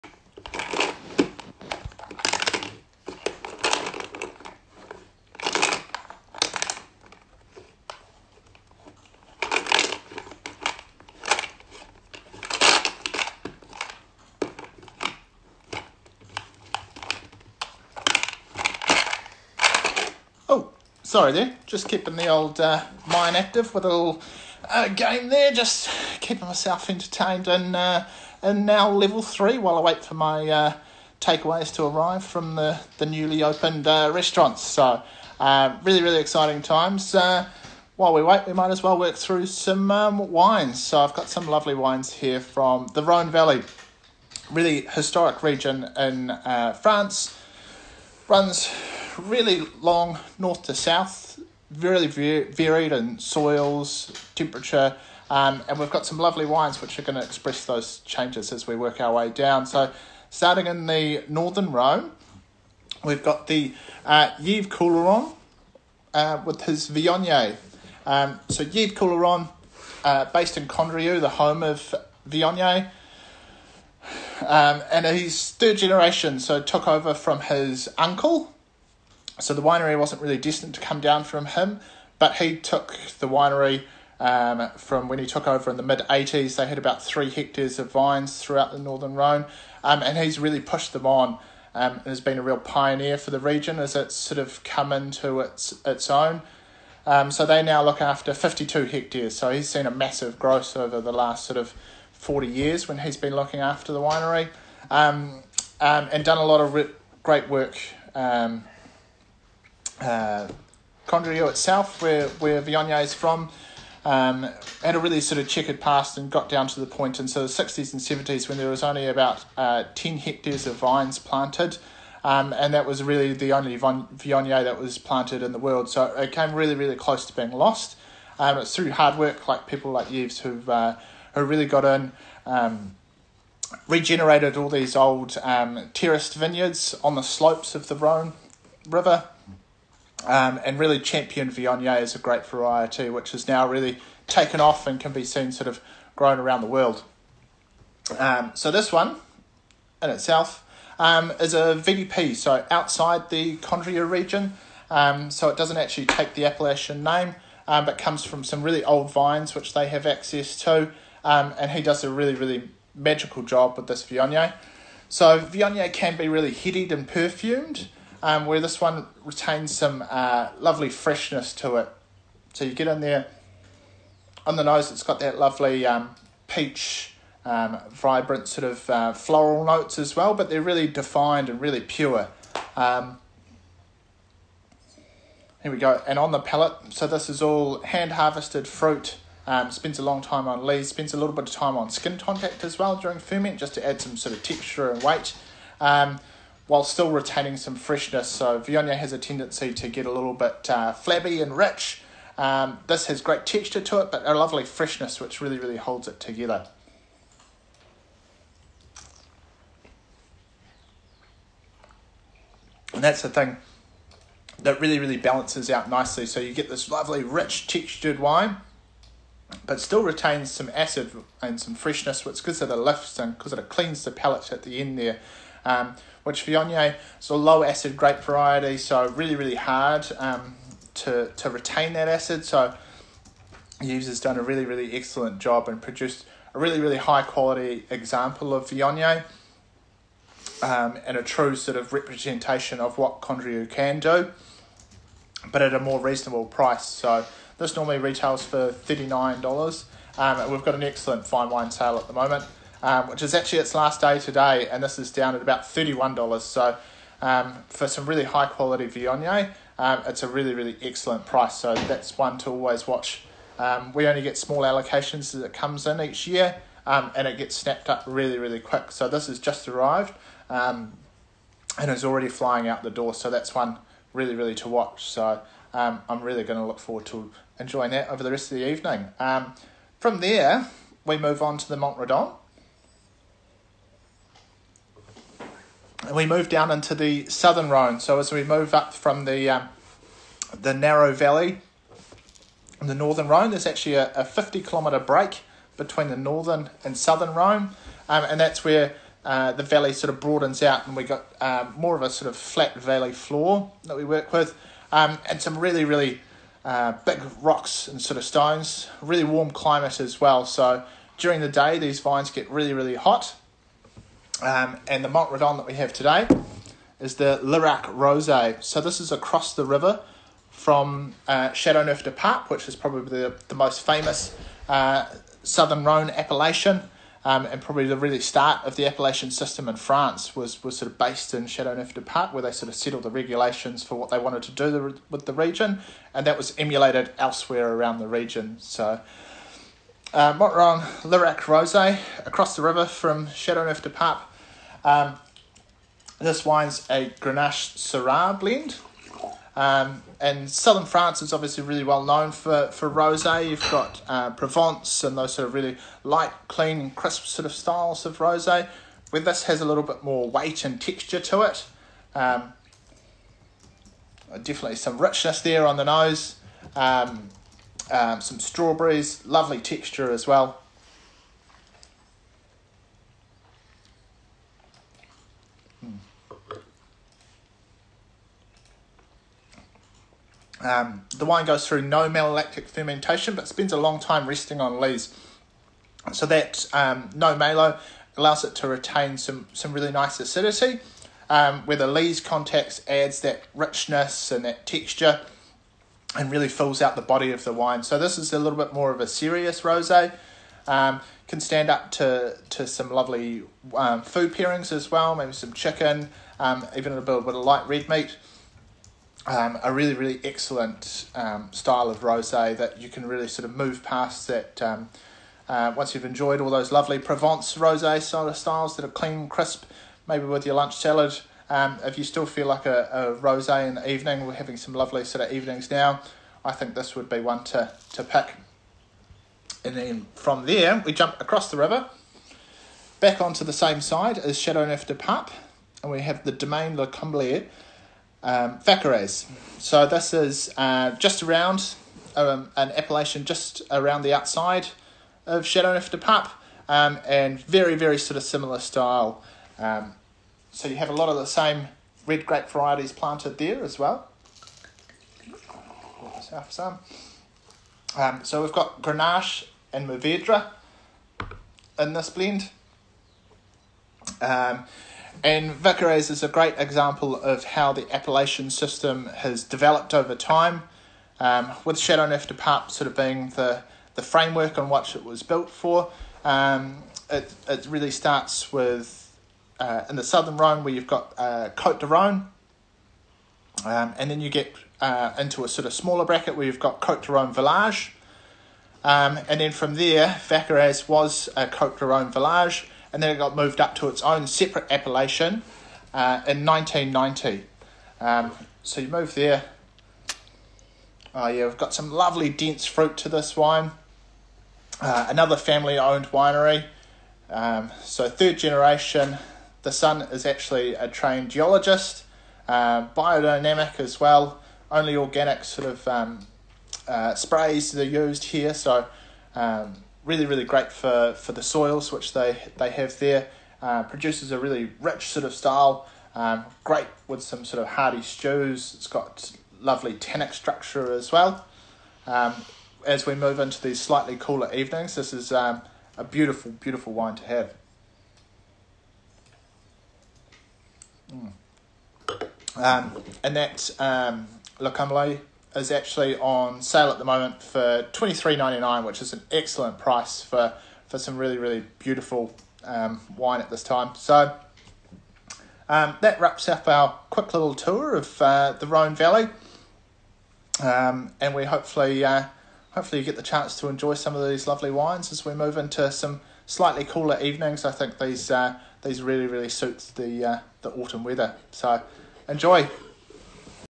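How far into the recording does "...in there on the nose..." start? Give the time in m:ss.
2:52.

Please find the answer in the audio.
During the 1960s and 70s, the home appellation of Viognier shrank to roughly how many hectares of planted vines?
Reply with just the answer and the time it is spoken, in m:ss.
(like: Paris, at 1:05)
10, at 1:59.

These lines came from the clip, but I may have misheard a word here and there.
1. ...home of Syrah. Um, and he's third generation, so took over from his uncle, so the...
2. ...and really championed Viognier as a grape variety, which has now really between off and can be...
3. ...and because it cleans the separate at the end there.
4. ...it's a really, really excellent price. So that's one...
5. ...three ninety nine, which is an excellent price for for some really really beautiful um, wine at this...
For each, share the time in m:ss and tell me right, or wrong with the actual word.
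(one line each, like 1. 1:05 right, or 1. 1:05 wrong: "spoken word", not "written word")
1. 1:11 wrong: "Viognier", not "Syrah"
2. 2:20 wrong: "taken", not "between"
3. 3:43 wrong: "palate", not "separate"
4. 4:20 right
5. 9:08 right.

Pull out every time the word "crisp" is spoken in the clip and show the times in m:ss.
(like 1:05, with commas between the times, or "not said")
5:56, 6:59.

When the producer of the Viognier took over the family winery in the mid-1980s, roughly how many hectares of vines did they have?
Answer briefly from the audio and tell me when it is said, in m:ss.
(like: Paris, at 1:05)
3, at 1:27.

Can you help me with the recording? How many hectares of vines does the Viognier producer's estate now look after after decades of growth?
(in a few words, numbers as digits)
52.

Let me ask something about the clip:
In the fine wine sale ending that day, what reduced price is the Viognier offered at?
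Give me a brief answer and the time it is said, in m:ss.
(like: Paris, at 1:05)
$31, at 4:15.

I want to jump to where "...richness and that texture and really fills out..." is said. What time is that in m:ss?
6:33.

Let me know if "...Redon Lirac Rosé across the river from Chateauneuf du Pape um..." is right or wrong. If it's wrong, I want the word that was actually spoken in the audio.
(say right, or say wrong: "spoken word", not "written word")
right.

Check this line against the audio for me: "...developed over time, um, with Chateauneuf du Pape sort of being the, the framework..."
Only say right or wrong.
right.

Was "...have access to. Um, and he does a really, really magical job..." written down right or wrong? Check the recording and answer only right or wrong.
right.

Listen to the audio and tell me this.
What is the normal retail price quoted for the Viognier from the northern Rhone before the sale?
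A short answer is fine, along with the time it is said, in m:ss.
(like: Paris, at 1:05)
$39, at 4:08.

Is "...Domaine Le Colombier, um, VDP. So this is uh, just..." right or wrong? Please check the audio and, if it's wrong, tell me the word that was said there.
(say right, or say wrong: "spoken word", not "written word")
wrong: "Vacqueyras", not "VDP".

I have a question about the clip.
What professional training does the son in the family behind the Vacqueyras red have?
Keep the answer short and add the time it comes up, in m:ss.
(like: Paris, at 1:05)
geologist, at 8:31.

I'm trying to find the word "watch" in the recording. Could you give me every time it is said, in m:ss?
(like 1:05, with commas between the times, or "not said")
4:22, 4:34.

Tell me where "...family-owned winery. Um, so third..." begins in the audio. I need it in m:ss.
8:25.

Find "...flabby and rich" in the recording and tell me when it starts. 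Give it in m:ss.
3:20.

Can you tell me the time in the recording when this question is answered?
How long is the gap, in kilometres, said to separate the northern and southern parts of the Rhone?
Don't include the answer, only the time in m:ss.
4:54.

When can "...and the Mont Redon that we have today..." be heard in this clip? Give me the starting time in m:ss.
5:14.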